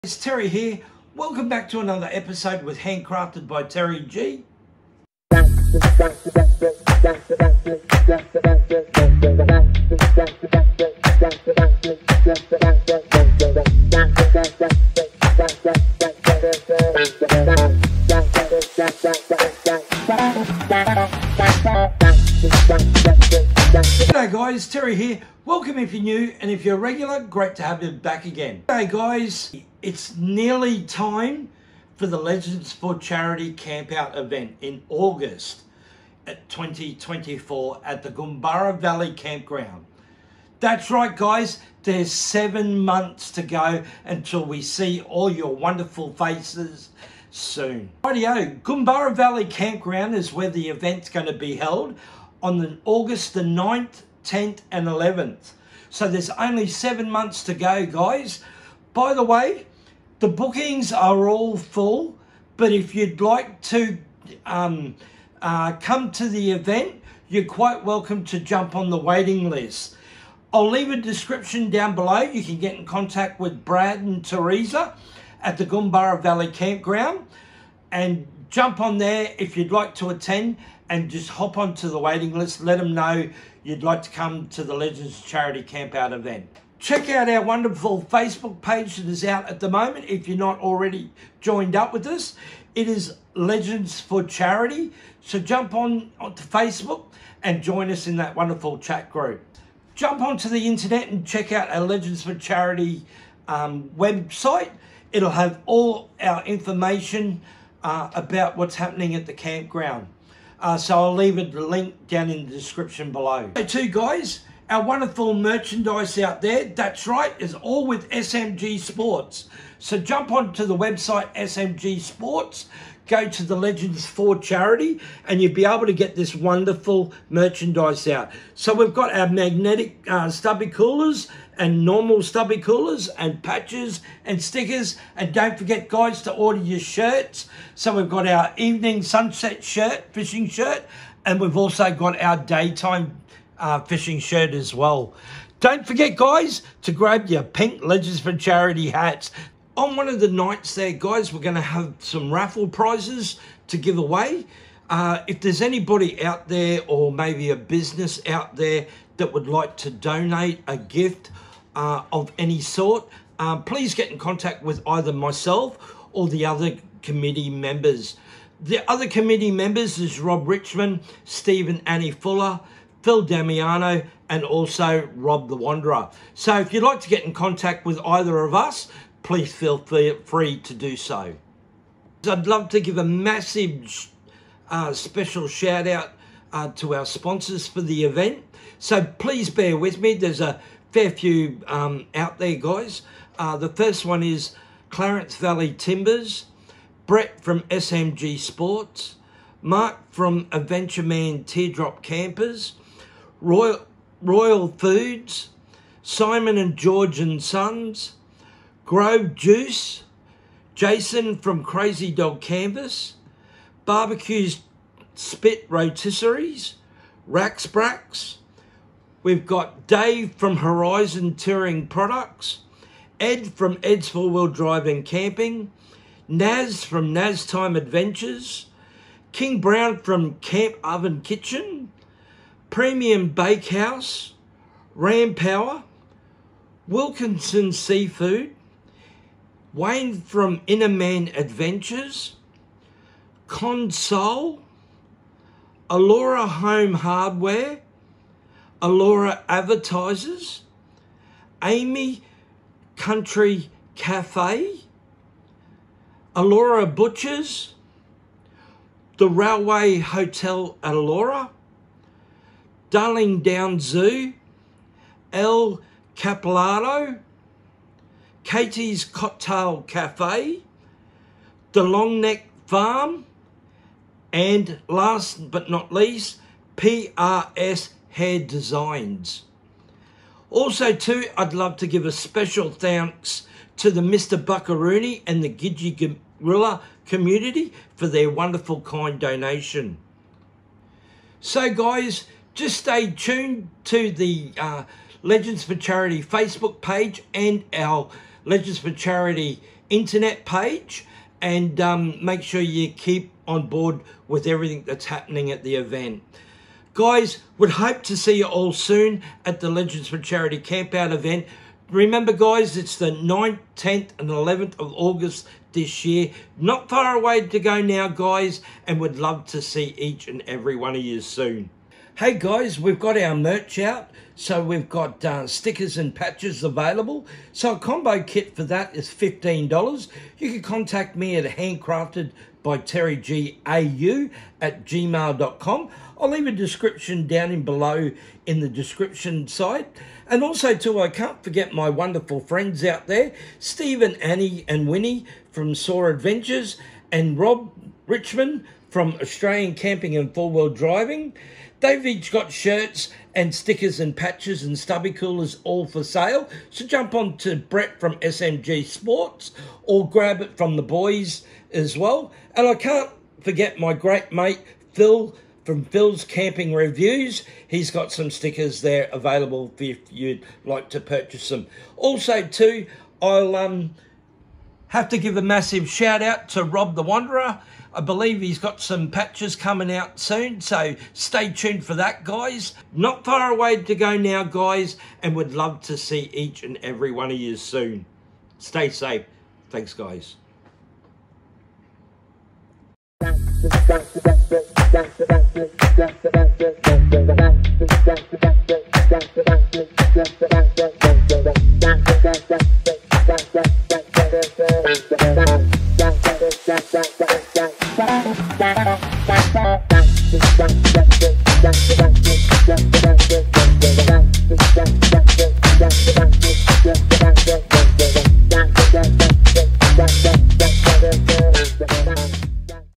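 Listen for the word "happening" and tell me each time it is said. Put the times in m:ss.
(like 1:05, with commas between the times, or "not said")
1:48, 5:05.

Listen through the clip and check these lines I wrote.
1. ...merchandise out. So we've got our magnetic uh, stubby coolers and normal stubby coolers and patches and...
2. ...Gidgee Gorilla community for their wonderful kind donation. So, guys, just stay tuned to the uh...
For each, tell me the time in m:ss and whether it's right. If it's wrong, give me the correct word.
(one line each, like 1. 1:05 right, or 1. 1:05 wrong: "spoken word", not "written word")
1. 2:07 right
2. 4:45 right.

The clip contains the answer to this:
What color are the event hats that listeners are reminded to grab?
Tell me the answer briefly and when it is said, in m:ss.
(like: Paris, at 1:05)
Pink, at 2:27.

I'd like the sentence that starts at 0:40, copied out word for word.
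That's right guys, there's seven months to go until we see all your wonderful faces soon.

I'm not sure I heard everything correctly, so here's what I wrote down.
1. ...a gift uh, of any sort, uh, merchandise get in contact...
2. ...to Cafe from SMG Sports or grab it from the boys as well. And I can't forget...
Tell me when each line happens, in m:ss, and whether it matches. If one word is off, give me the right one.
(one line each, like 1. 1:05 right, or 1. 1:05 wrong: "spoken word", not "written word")
1. 2:40 wrong: "please", not "merchandise"
2. 5:57 wrong: "Brett", not "Cafe".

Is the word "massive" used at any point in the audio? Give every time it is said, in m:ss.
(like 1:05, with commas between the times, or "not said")
3:03, 6:15.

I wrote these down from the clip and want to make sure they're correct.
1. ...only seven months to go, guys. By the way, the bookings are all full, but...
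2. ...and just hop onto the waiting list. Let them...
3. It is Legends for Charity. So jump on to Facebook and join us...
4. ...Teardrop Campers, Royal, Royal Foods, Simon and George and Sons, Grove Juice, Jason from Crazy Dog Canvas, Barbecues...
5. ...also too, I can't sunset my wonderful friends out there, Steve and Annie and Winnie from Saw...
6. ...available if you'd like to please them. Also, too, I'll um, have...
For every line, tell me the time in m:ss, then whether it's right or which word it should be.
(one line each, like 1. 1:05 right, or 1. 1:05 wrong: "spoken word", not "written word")
1. 0:56 right
2. 1:20 right
3. 1:32 right
4. 3:21 right
5. 5:40 wrong: "forget", not "sunset"
6. 6:09 wrong: "purchase", not "please".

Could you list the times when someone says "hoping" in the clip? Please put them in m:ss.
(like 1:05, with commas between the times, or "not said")
not said.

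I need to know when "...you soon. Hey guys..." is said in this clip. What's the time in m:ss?
5:21.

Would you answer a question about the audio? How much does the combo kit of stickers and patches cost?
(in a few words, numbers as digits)
$15.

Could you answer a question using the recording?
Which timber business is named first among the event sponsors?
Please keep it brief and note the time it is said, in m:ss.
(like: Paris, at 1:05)
Clarence Valley Timbers, at 3:14.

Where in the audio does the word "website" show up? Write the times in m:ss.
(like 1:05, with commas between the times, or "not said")
1:43, 2:00.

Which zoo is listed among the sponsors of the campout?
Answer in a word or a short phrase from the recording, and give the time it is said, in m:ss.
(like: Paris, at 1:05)
Darling Down Zoo, at 4:22.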